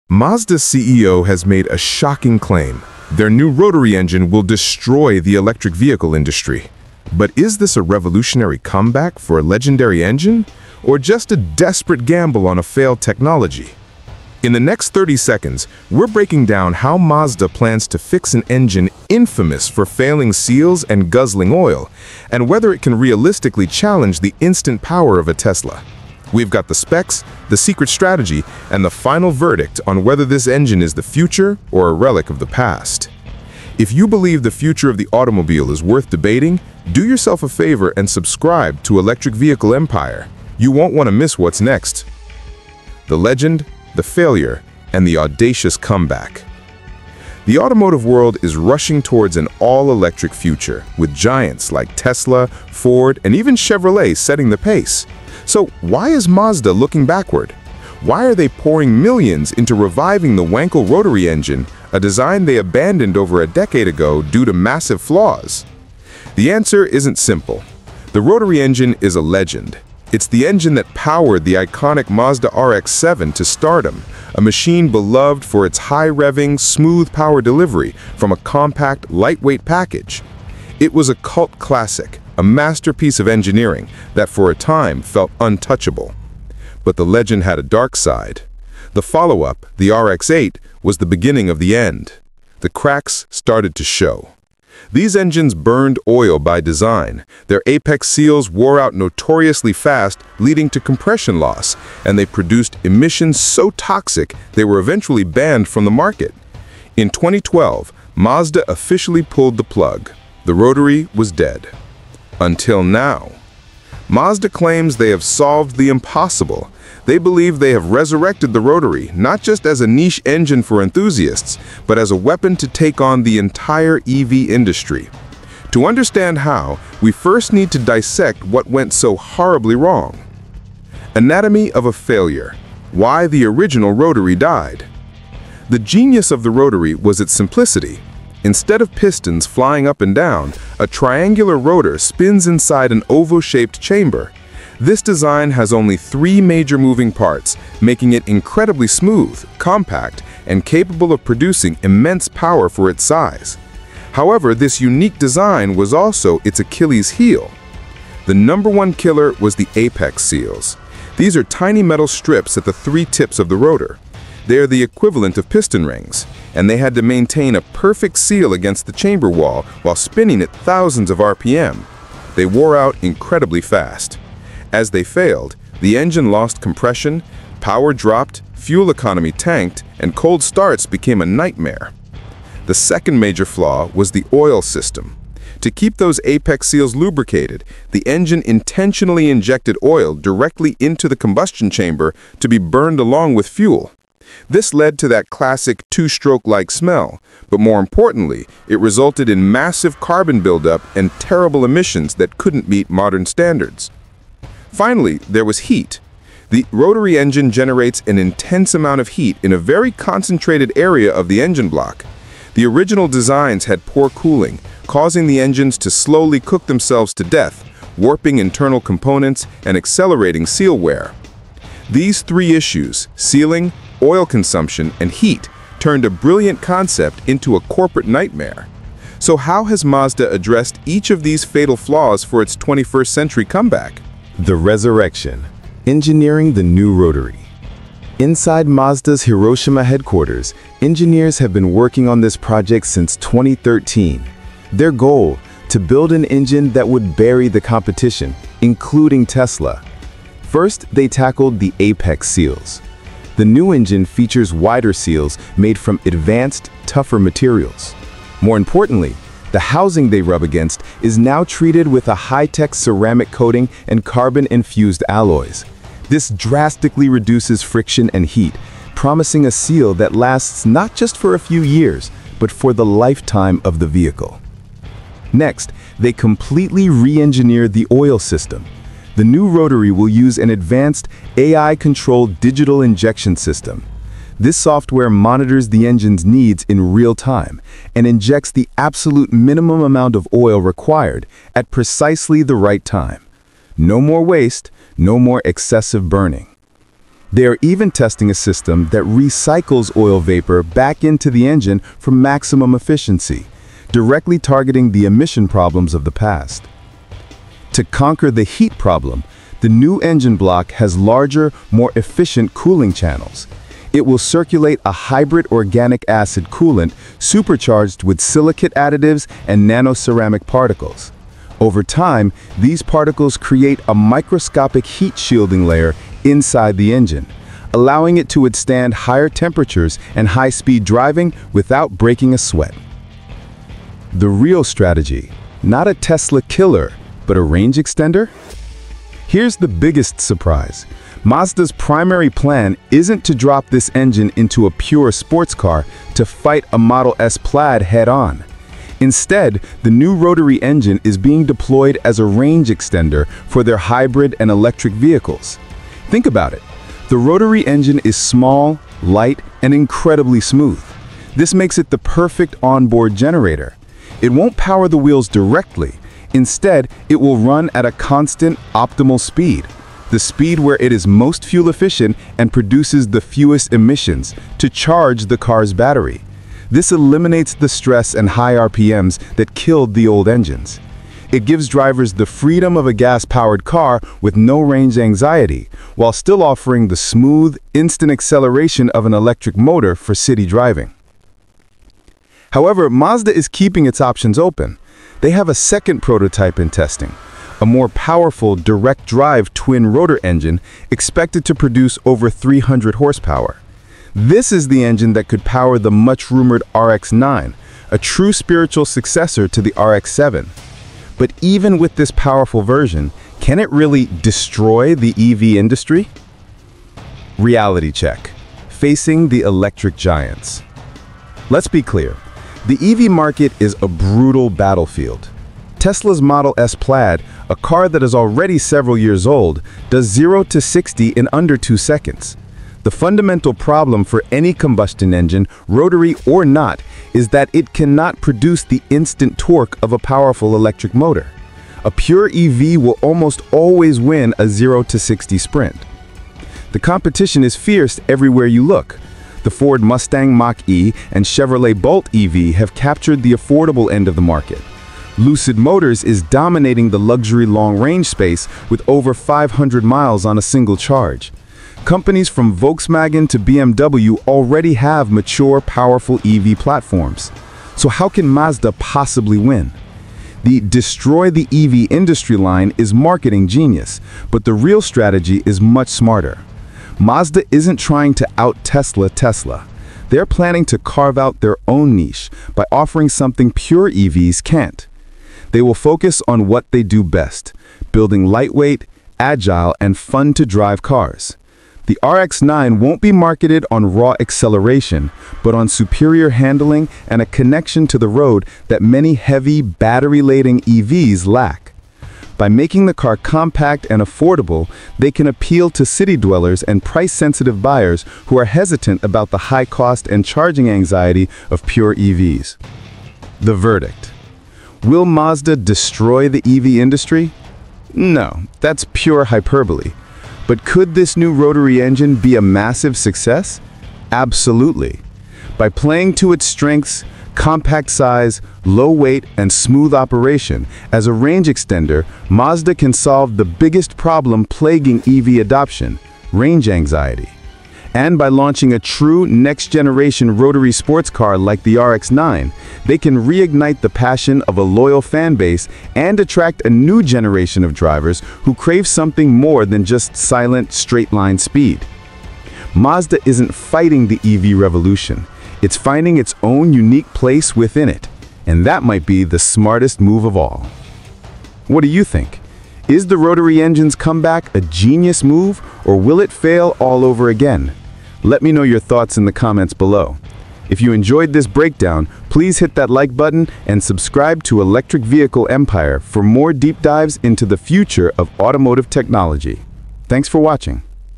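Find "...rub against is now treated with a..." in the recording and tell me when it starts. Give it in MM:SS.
04:20.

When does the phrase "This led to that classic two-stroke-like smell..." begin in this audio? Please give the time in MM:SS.
03:14.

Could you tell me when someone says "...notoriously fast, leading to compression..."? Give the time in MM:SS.
01:38.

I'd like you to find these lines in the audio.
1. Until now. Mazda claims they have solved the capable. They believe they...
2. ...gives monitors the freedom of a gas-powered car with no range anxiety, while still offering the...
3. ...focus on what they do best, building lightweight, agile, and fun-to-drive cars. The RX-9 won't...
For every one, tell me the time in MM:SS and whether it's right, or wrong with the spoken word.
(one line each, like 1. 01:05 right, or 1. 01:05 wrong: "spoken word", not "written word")
1. 01:52 wrong: "impossible", not "capable"
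2. 06:21 wrong: "drivers", not "monitors"
3. 08:05 right.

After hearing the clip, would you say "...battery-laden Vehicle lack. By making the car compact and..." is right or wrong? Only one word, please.
wrong.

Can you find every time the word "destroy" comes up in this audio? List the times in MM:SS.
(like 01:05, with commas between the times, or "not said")
00:04, 06:54, 07:50, 08:35.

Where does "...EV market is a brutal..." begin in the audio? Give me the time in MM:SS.
07:02.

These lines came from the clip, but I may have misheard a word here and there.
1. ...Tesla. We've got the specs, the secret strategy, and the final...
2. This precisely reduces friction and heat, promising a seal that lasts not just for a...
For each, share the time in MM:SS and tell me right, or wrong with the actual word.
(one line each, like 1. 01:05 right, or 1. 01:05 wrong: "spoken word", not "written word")
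1. 00:25 right
2. 04:26 wrong: "drastically", not "precisely".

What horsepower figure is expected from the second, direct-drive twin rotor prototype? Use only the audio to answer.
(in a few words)
Over 300.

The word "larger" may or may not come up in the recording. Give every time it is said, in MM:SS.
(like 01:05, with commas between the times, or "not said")
05:10.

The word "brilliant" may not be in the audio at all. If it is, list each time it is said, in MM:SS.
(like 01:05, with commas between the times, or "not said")
03:46.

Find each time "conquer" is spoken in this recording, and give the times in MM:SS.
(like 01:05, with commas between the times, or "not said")
05:07.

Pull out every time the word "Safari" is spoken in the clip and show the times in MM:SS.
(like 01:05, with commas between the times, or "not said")
not said.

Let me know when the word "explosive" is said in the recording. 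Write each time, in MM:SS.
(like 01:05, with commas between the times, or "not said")
not said.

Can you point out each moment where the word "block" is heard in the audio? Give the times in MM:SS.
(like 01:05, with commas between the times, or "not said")
03:31, 05:10.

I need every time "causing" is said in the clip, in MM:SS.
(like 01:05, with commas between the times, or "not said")
03:34.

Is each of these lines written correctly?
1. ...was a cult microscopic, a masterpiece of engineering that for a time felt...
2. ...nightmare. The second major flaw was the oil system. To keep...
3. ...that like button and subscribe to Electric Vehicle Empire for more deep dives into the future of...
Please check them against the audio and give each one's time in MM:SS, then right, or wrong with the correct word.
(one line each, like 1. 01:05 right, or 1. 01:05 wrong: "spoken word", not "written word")
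1. 01:20 wrong: "classic", not "microscopic"
2. 03:01 right
3. 09:32 right.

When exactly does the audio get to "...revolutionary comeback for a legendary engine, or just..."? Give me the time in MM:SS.
00:07.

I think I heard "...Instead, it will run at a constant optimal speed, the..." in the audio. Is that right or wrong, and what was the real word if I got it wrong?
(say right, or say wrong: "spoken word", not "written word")
right.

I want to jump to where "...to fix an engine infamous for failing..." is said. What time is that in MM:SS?
00:17.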